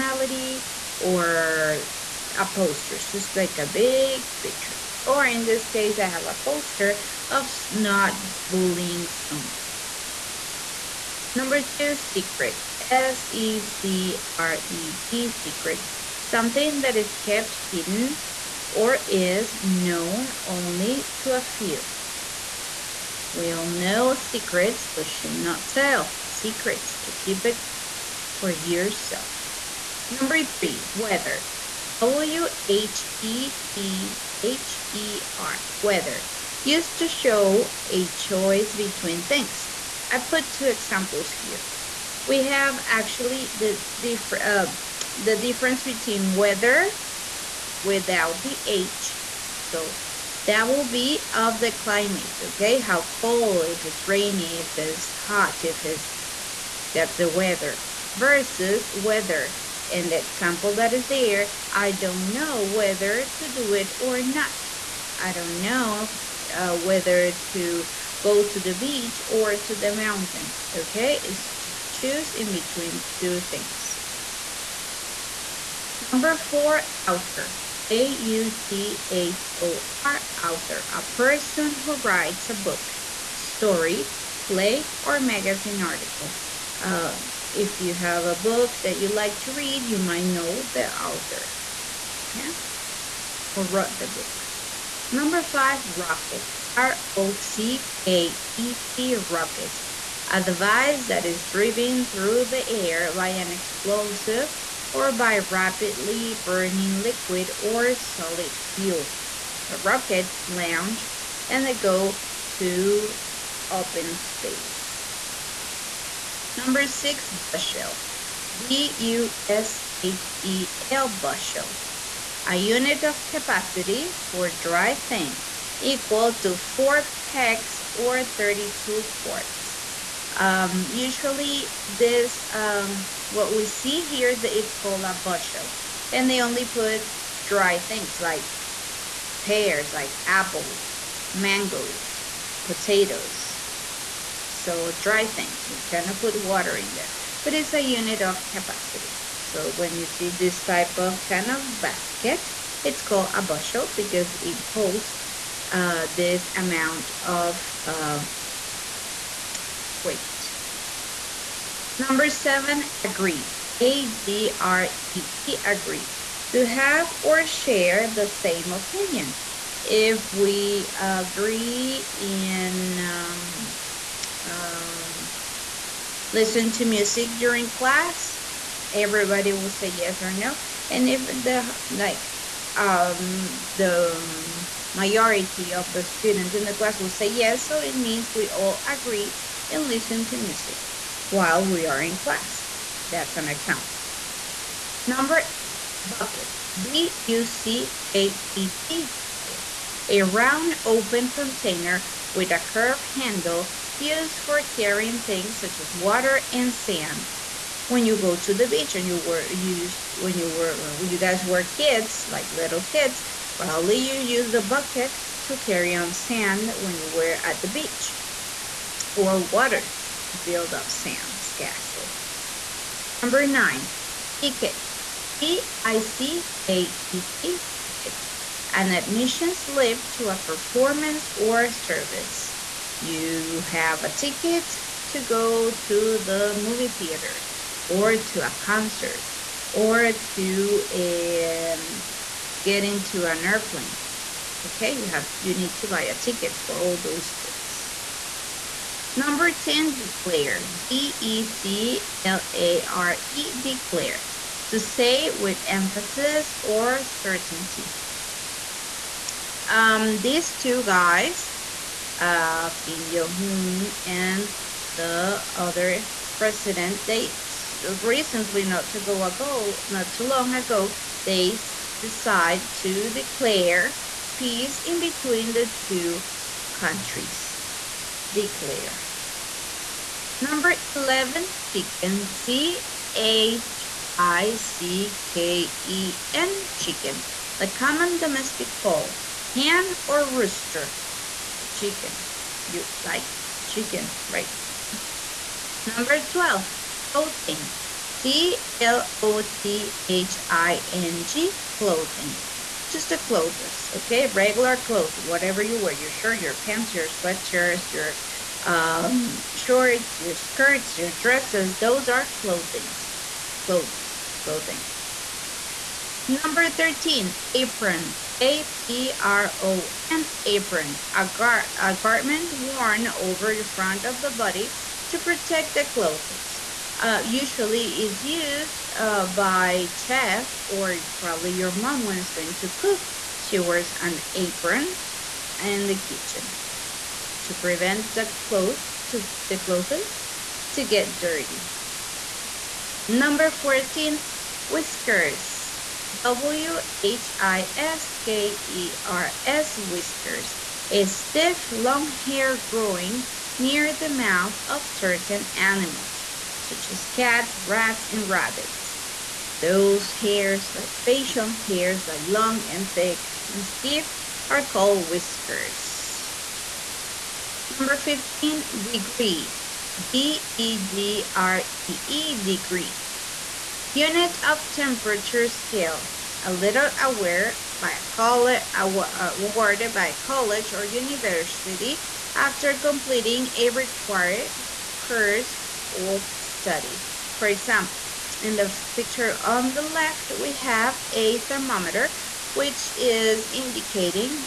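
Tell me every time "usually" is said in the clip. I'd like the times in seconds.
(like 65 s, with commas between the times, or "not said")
130 s, 327 s.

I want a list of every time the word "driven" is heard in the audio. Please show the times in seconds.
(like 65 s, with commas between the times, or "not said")
101 s.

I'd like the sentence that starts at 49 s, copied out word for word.
So that will be of the climate, okay?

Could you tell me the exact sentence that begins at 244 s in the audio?
Okay, you have you need to buy a ticket for all those things.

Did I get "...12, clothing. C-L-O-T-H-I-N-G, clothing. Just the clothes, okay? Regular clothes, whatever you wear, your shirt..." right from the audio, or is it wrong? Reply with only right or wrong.
right.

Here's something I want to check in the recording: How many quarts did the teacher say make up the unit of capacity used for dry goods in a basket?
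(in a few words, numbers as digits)
32.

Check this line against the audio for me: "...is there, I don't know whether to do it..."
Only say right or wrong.
right.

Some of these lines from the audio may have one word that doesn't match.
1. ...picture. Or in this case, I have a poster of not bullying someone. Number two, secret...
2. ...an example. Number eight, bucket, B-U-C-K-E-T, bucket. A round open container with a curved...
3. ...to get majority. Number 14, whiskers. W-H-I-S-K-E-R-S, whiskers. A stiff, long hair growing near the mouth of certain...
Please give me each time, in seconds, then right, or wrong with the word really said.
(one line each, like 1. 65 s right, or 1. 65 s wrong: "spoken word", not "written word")
1. 4 s right
2. 193 s right
3. 340 s wrong: "dirty", not "majority".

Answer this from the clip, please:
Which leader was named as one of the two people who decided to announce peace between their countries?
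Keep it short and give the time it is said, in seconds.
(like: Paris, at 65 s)
Kim Jong-un, at 262 s.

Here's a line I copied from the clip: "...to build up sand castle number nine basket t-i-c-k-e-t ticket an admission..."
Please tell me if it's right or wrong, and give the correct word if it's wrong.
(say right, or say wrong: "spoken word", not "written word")
wrong: "ticket", not "basket".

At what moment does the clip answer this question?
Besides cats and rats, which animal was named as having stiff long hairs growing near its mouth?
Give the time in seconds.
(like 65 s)
358 s.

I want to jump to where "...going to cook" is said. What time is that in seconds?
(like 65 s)
332 s.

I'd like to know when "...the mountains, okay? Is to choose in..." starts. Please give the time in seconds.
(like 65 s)
69 s.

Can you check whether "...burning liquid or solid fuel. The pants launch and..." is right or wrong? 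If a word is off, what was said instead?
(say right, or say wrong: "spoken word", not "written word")
wrong: "rockets", not "pants".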